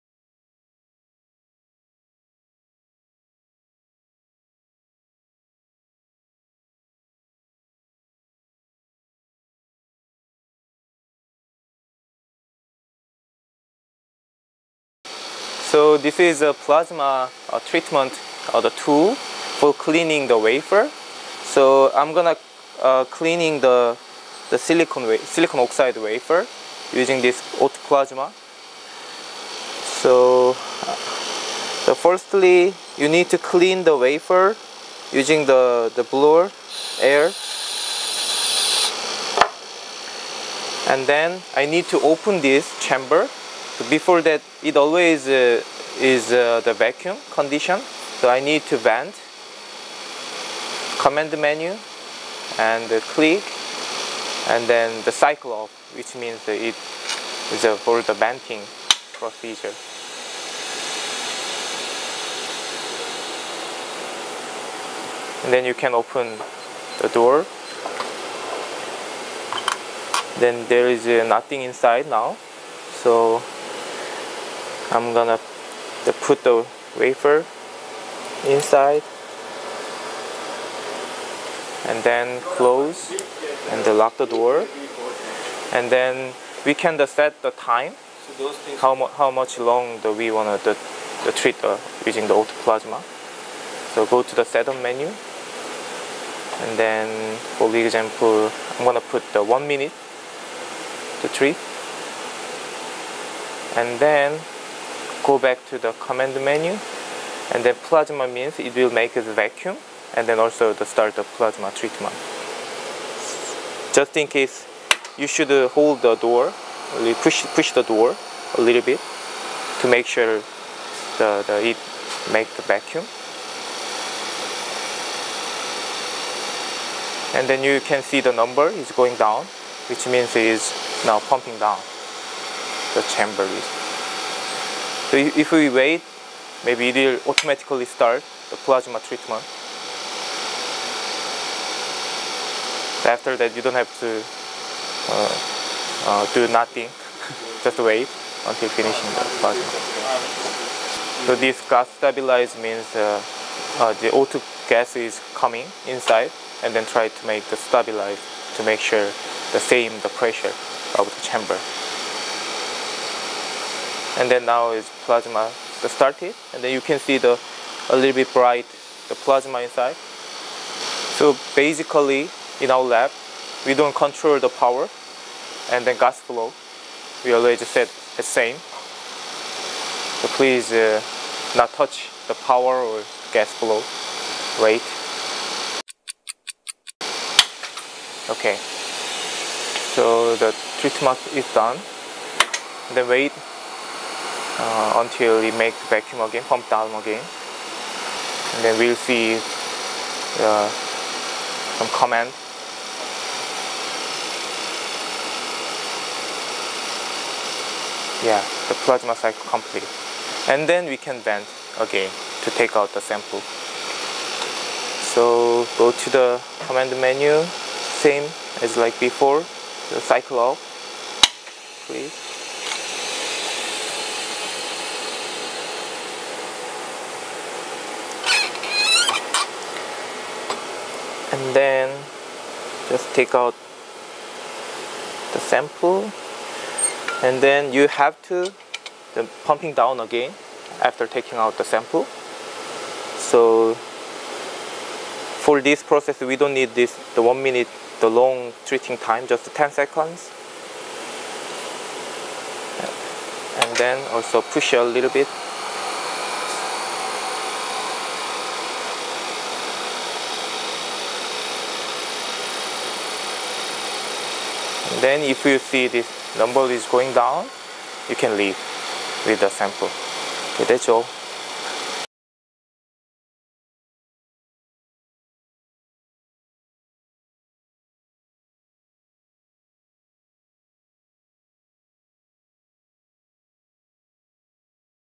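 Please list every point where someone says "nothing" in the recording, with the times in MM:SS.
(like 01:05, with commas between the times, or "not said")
01:11, 02:26.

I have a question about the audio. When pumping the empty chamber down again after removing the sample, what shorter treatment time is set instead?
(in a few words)
10 seconds.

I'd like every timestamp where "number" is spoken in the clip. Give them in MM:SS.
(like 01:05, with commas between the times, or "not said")
02:08, 04:26.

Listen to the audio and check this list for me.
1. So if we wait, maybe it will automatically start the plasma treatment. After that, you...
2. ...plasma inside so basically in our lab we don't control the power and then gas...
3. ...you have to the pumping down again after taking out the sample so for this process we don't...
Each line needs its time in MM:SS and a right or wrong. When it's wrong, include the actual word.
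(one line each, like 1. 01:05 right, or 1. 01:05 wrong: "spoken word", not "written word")
1. 02:15 right
2. 02:49 right
3. 03:57 right.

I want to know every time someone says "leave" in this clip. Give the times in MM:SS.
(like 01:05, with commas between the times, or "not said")
04:28.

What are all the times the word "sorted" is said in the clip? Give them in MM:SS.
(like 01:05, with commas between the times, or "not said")
not said.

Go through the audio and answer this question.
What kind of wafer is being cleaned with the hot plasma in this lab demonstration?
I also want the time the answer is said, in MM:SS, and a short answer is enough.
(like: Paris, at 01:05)
silicon oxide, at 00:25.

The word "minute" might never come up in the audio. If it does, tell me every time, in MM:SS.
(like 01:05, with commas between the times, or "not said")
01:39, 04:07.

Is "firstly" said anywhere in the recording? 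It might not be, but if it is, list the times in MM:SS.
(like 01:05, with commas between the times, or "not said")
00:31.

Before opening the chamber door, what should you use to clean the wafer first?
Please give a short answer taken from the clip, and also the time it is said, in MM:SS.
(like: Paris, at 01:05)
blower air, at 00:36.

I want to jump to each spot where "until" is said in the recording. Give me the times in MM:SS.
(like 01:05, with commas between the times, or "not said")
02:28, 03:15.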